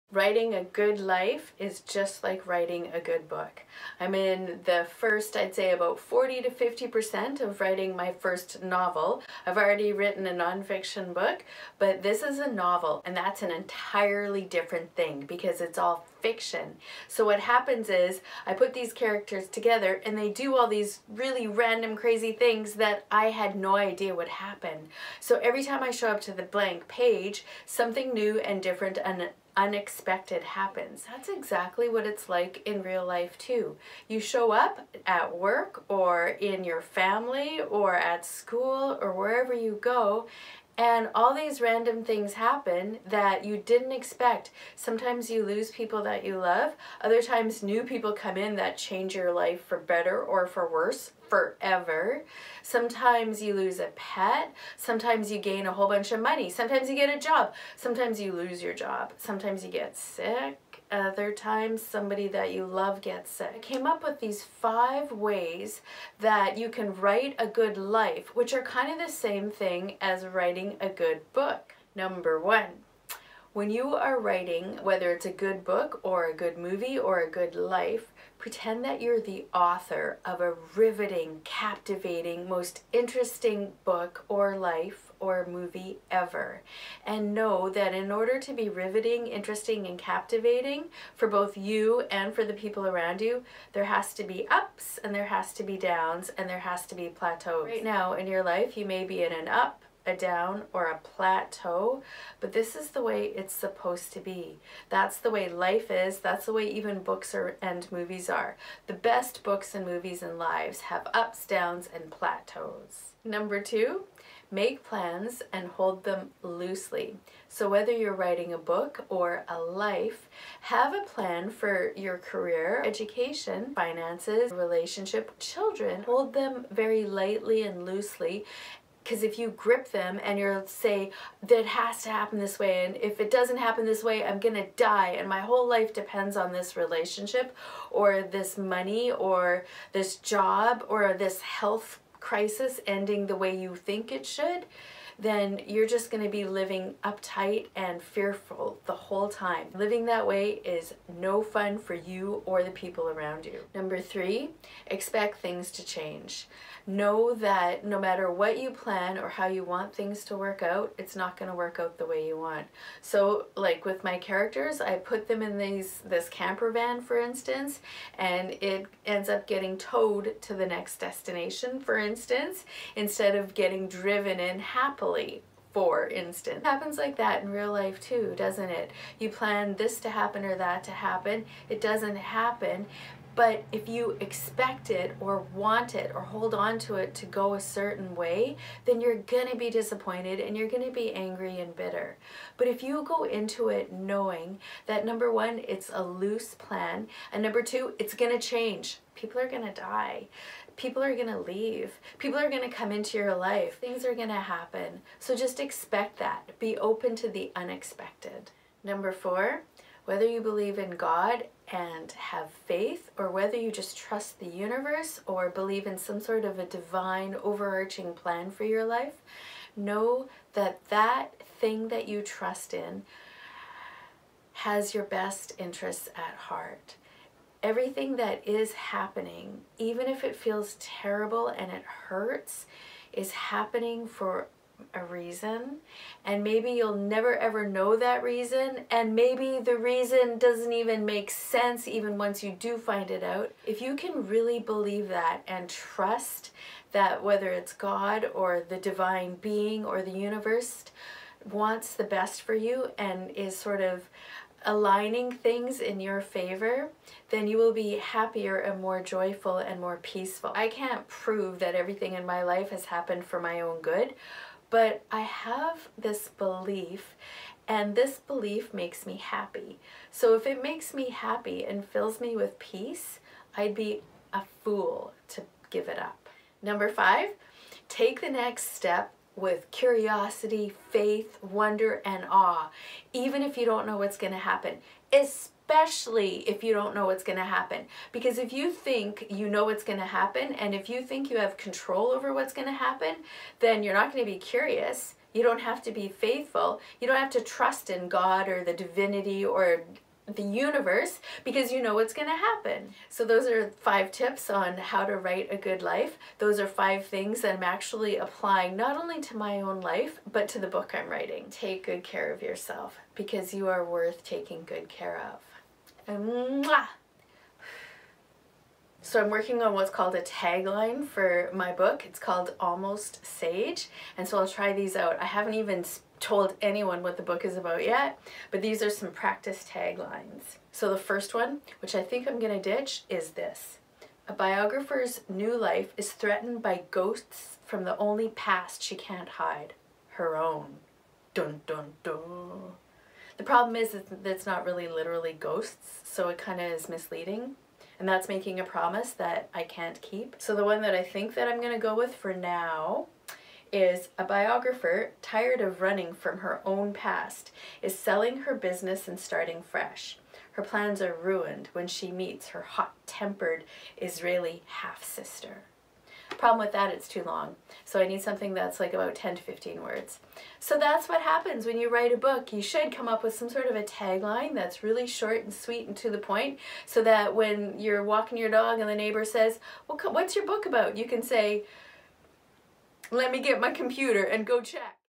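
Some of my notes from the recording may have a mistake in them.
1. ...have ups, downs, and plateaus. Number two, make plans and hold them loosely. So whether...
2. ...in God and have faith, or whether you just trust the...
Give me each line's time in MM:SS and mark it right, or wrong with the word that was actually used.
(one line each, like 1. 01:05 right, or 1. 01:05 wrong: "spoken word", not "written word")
1. 01:50 right
2. 03:30 right.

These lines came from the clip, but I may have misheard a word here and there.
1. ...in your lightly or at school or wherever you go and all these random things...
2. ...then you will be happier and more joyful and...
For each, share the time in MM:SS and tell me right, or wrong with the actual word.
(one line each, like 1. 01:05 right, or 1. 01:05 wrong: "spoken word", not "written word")
1. 00:36 wrong: "family", not "lightly"
2. 04:17 right.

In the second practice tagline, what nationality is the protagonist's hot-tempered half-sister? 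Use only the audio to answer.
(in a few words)
Israeli.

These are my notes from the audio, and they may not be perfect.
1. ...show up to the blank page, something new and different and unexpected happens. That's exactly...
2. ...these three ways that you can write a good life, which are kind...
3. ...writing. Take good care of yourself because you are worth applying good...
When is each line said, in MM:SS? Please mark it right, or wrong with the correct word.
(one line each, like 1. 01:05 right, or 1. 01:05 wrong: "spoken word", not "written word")
1. 00:25 right
2. 01:04 wrong: "five", not "three"
3. 05:11 wrong: "taking", not "applying".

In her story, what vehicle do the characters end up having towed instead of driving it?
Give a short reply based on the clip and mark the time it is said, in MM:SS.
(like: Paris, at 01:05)
camper van, at 02:46.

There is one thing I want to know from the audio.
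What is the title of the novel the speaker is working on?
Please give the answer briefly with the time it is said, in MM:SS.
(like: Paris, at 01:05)
Almost Sage, at 05:22.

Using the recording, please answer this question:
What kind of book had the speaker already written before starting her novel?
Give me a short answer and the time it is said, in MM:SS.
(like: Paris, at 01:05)
nonfiction, at 00:10.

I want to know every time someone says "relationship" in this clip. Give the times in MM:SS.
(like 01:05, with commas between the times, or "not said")
02:04, 02:16.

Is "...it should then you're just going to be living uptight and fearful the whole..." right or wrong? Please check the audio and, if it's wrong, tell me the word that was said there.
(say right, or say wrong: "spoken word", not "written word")
right.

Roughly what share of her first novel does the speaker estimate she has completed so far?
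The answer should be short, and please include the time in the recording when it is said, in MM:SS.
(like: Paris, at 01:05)
40 to 50%, at 00:05.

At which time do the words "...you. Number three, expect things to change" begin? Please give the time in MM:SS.
02:33.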